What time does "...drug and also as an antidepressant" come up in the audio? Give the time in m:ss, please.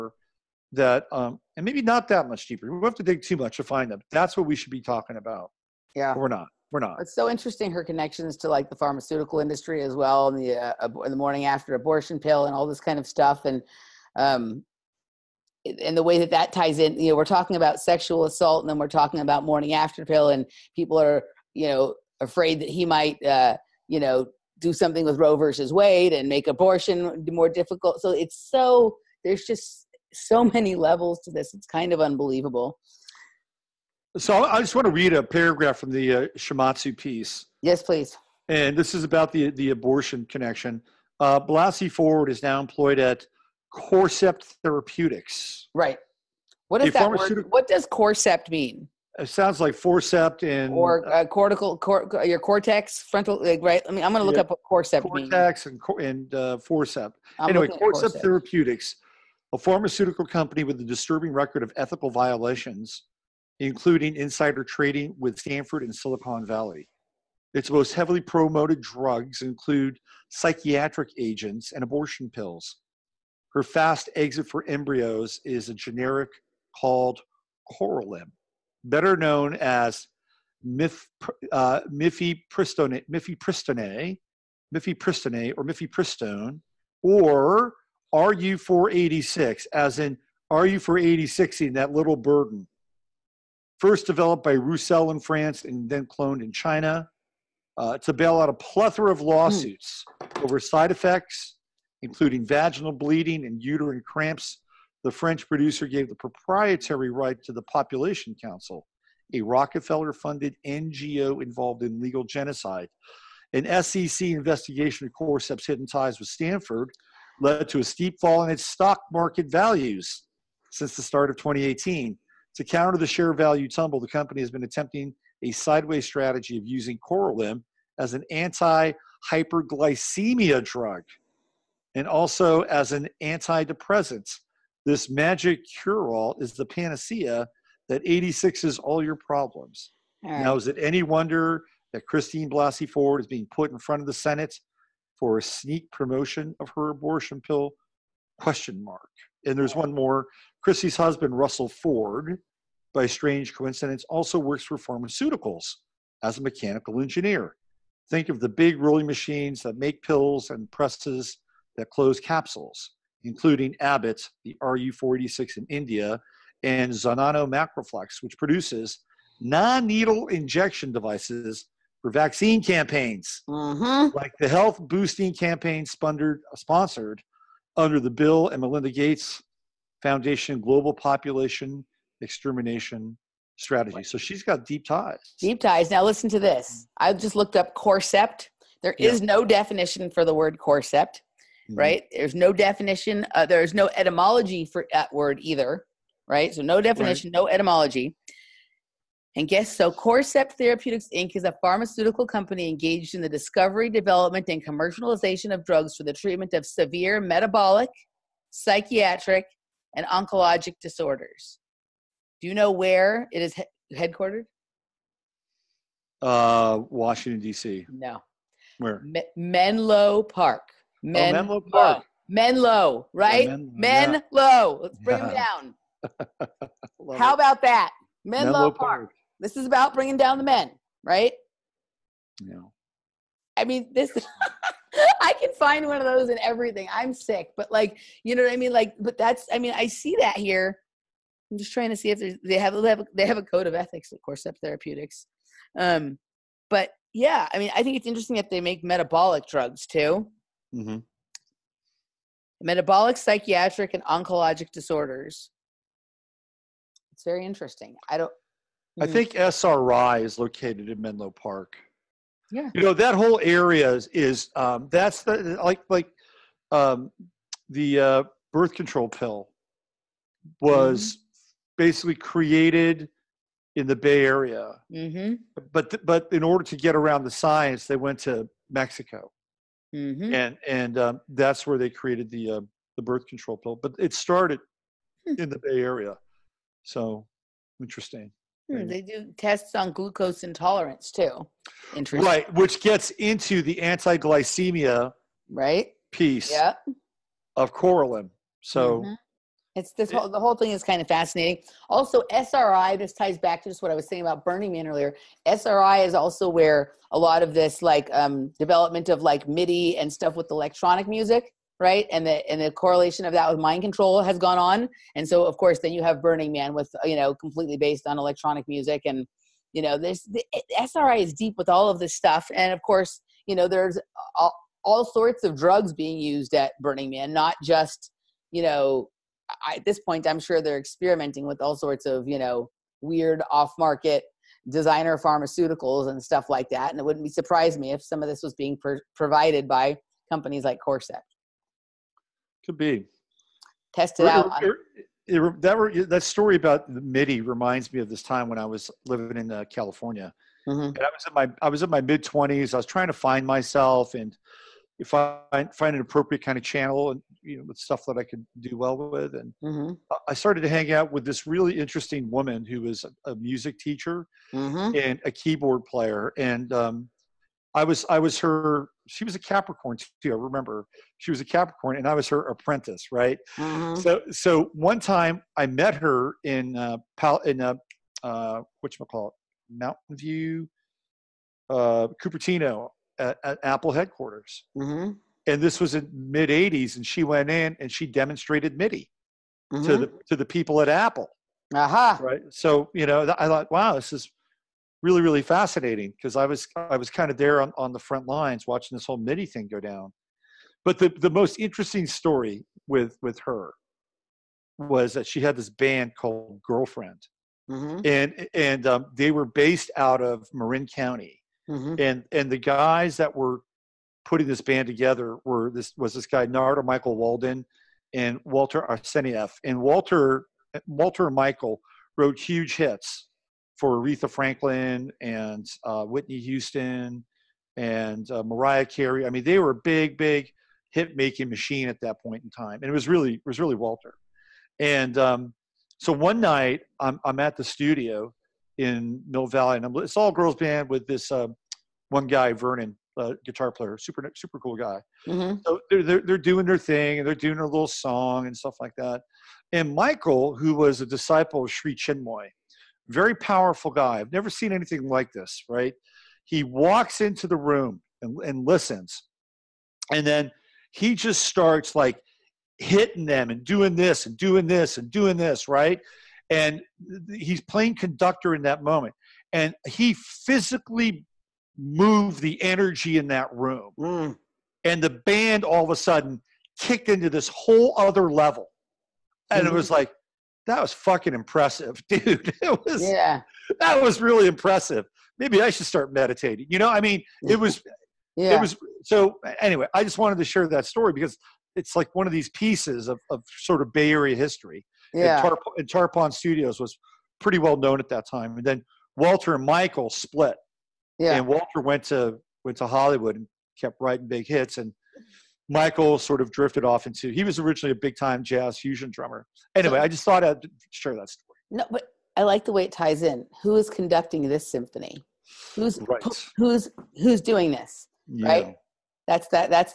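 2:10.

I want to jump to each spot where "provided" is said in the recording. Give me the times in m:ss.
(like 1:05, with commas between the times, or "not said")
5:39.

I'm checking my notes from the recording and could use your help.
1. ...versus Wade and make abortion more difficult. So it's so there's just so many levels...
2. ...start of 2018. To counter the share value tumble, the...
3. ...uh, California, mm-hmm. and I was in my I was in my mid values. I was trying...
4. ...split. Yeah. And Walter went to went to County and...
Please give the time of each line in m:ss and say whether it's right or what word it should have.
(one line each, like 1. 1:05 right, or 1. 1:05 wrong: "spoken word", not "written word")
1. 0:25 right
2. 2:01 right
3. 5:49 wrong: "twenties", not "values"
4. 8:20 wrong: "Hollywood", not "County".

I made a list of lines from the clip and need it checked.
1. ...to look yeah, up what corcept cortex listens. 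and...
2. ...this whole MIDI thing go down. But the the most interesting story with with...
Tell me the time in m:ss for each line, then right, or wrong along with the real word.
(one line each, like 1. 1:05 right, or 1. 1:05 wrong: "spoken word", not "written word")
1. 0:54 wrong: "means", not "listens"
2. 6:38 right.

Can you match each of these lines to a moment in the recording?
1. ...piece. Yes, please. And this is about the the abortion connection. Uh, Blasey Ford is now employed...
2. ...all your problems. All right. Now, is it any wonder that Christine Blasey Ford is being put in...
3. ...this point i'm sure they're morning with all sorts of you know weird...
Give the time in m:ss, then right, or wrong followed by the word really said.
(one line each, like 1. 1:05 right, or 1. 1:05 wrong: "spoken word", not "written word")
1. 0:36 right
2. 2:18 right
3. 5:29 wrong: "experimenting", not "morning".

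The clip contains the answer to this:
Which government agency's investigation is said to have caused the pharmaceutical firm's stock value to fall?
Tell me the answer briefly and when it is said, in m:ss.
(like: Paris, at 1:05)
SEC, at 1:53.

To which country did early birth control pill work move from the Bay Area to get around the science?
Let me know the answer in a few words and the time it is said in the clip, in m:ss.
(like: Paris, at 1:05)
Mexico, at 4:38.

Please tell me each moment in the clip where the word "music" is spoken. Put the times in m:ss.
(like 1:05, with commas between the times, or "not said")
5:11, 5:18, 6:03.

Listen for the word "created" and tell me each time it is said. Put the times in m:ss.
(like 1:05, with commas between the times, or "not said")
4:32, 4:41.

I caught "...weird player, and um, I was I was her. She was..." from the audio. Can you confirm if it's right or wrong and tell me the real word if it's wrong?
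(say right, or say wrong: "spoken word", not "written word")
wrong: "keyboard", not "weird".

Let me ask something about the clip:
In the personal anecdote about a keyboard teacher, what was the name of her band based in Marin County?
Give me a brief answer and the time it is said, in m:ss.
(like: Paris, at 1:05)
Girlfriend, at 6:46.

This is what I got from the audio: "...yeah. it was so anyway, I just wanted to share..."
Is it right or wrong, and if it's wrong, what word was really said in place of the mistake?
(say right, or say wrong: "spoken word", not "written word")
right.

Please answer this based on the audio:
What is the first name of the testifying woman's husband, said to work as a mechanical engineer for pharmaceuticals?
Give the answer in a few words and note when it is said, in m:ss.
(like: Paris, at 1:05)
Russell, at 2:31.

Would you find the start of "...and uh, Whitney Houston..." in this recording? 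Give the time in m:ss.
7:05.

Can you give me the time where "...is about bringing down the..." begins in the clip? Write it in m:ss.
3:49.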